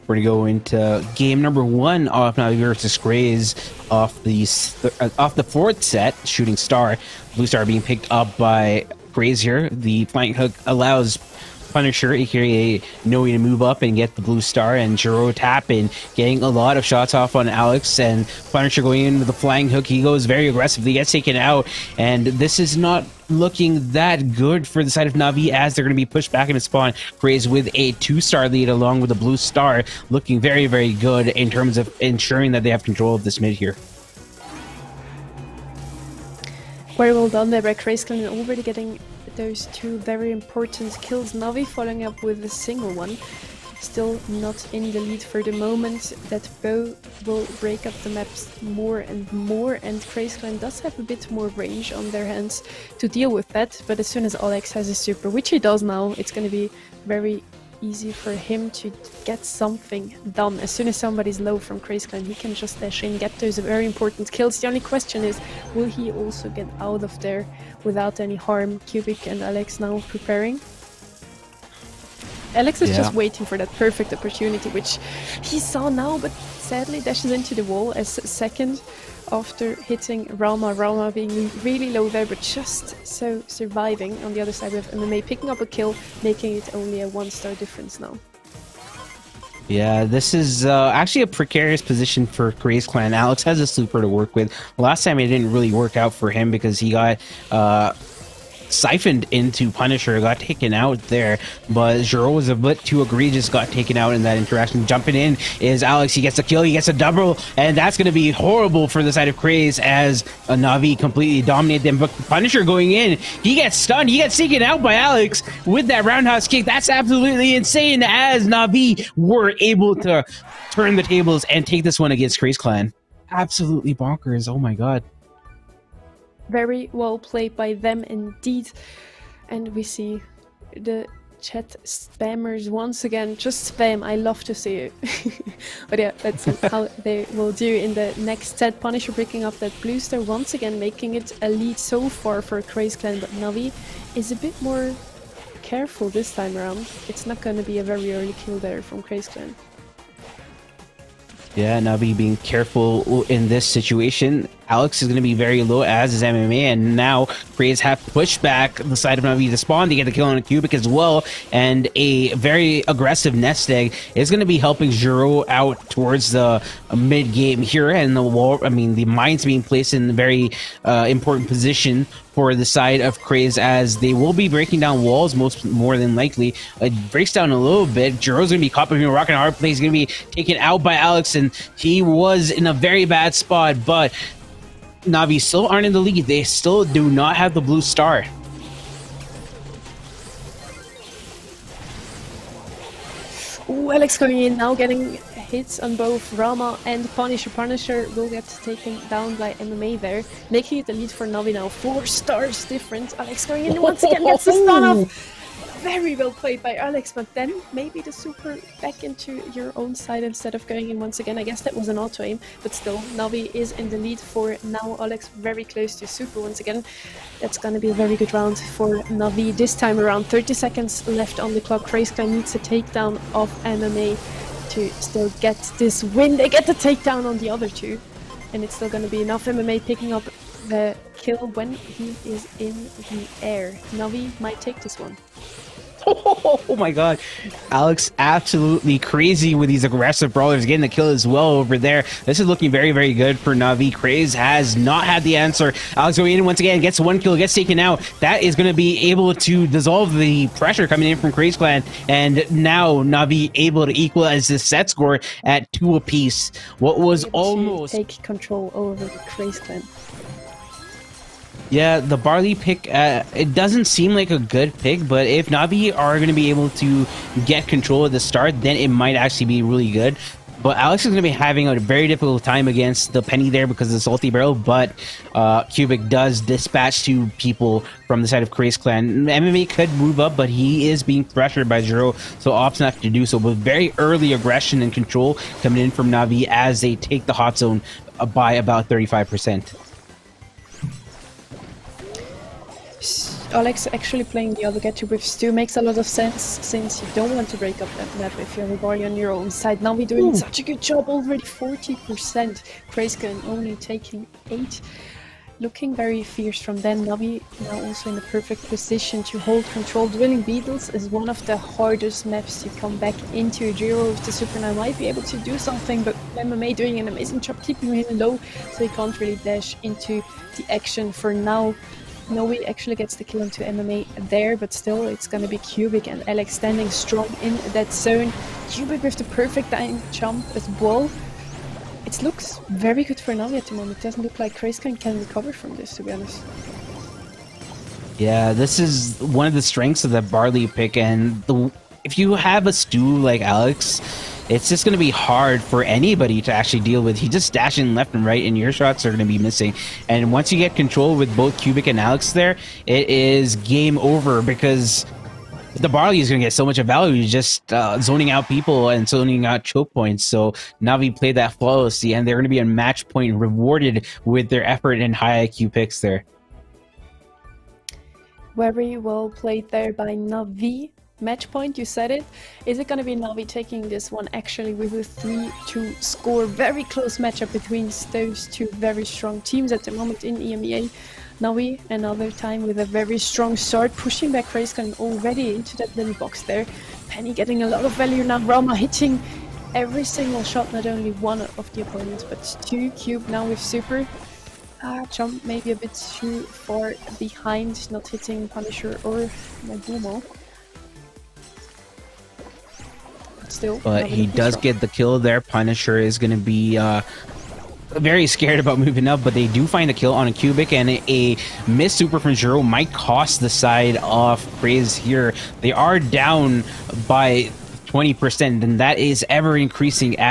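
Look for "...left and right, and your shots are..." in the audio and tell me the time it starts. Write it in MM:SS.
05:47.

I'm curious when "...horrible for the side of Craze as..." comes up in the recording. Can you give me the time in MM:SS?
01:48.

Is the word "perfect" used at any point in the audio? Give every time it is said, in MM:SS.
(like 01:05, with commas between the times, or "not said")
01:13, 05:08, 05:29.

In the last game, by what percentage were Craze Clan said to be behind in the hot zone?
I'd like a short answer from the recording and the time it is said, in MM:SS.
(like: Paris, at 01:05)
20%, at 06:57.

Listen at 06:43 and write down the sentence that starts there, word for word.
Still, but he does get the kill there.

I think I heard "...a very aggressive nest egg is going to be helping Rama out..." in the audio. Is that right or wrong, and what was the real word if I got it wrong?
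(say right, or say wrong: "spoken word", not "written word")
wrong: "Jiro", not "Rama".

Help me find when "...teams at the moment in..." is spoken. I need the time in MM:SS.
06:19.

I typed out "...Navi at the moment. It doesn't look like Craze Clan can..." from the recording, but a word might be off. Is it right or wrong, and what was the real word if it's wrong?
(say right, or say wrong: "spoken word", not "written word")
right.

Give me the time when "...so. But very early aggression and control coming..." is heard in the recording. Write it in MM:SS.
04:43.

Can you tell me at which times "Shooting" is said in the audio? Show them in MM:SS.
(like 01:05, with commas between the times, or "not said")
00:06.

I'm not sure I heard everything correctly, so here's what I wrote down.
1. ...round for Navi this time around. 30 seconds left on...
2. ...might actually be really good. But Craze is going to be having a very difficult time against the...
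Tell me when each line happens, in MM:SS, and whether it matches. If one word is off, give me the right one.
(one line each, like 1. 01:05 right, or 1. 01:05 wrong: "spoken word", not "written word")
1. 03:38 right
2. 04:28 wrong: "Alex", not "Craze".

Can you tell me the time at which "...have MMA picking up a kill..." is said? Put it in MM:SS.
01:24.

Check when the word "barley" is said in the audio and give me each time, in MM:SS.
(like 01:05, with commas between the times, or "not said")
04:22, 05:40, 05:55.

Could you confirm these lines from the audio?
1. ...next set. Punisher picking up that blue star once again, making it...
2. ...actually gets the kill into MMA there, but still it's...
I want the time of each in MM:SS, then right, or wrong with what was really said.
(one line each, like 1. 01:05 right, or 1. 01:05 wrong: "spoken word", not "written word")
1. 02:18 right
2. 05:22 right.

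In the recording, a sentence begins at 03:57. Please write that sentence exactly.
Alex absolutely crazy with these aggressive brawlers.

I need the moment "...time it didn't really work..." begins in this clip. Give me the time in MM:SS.
01:35.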